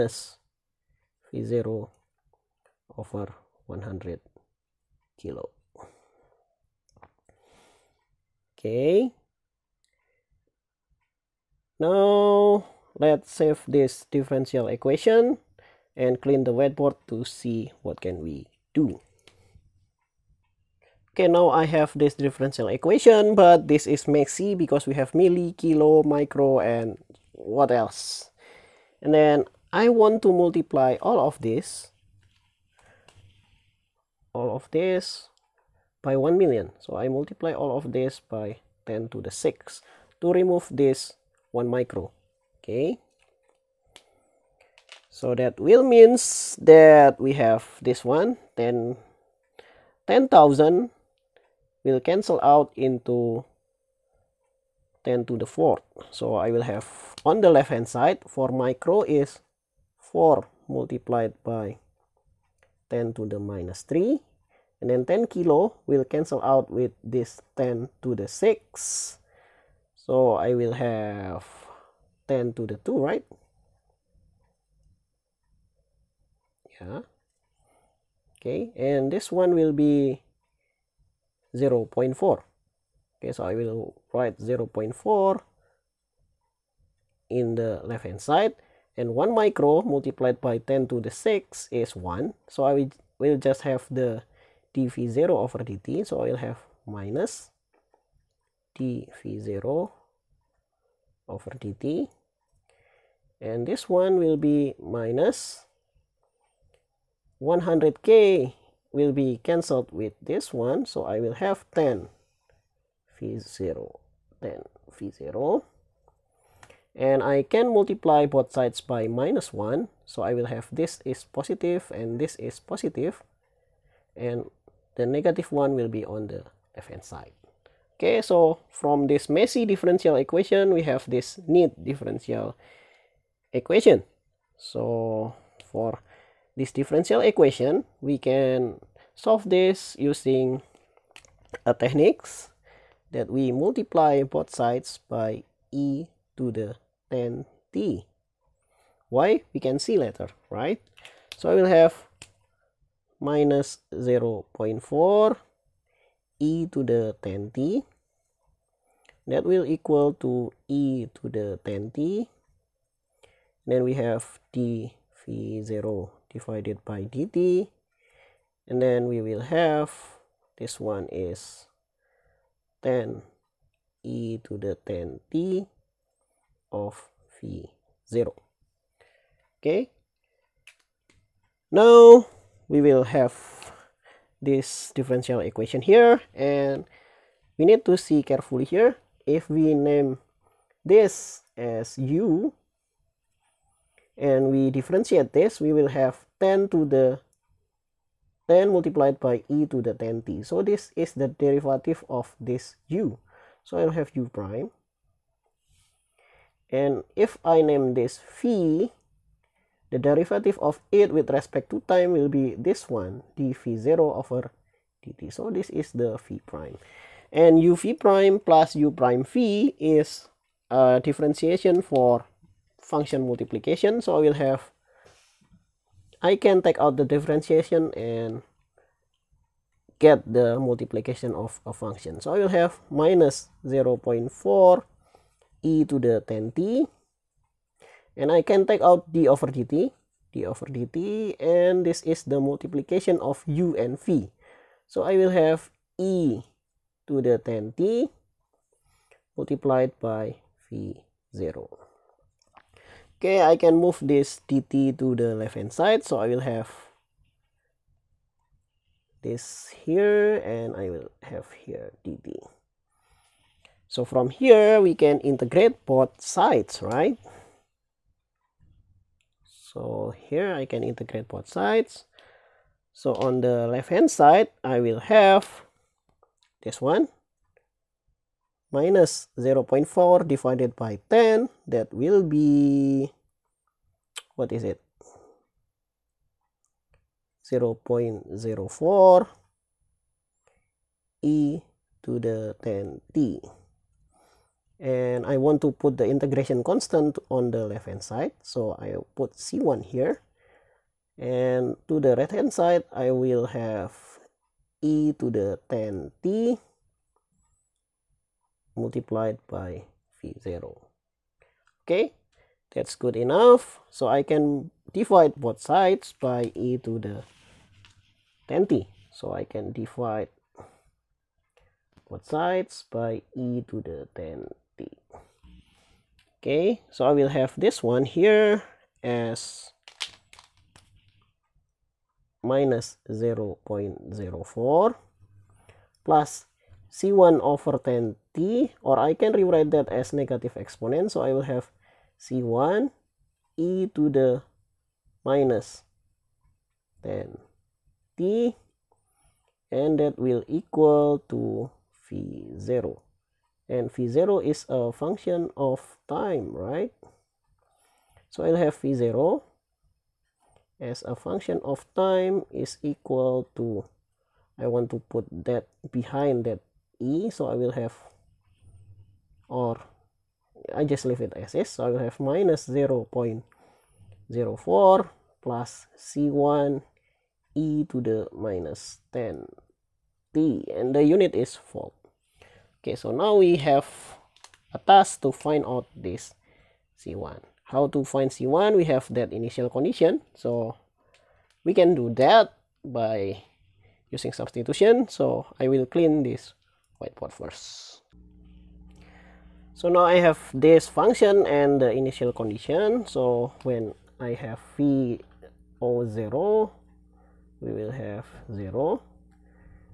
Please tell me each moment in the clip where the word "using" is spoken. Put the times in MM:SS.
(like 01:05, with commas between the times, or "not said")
02:19, 06:34.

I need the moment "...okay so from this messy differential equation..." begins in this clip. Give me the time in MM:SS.
02:07.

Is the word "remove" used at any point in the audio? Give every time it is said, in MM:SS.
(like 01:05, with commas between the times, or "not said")
00:40.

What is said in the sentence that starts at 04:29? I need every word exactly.
So here I can integrate both sides.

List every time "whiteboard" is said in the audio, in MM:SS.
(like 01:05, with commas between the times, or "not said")
00:16, 06:36.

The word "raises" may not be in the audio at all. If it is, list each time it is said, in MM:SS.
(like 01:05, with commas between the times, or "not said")
not said.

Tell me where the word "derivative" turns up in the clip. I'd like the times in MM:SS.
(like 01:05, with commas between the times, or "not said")
03:21, 03:30.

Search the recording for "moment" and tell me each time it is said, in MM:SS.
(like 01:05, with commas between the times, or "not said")
not said.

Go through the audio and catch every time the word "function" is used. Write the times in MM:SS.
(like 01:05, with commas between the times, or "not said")
03:42, 03:51, 05:54, 06:01, 06:40.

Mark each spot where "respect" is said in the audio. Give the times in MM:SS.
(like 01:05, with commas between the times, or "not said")
03:31.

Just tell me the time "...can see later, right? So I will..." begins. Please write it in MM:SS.
02:29.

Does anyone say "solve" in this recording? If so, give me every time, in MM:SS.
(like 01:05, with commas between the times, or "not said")
02:19.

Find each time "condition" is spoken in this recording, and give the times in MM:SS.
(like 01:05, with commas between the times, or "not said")
06:29, 06:42.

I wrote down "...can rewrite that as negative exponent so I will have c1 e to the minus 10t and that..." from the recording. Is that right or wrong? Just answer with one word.
right.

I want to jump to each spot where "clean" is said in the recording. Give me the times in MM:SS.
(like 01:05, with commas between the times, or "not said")
00:16, 06:35.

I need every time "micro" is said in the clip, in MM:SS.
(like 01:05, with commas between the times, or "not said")
00:26, 00:41, 00:58, 01:29.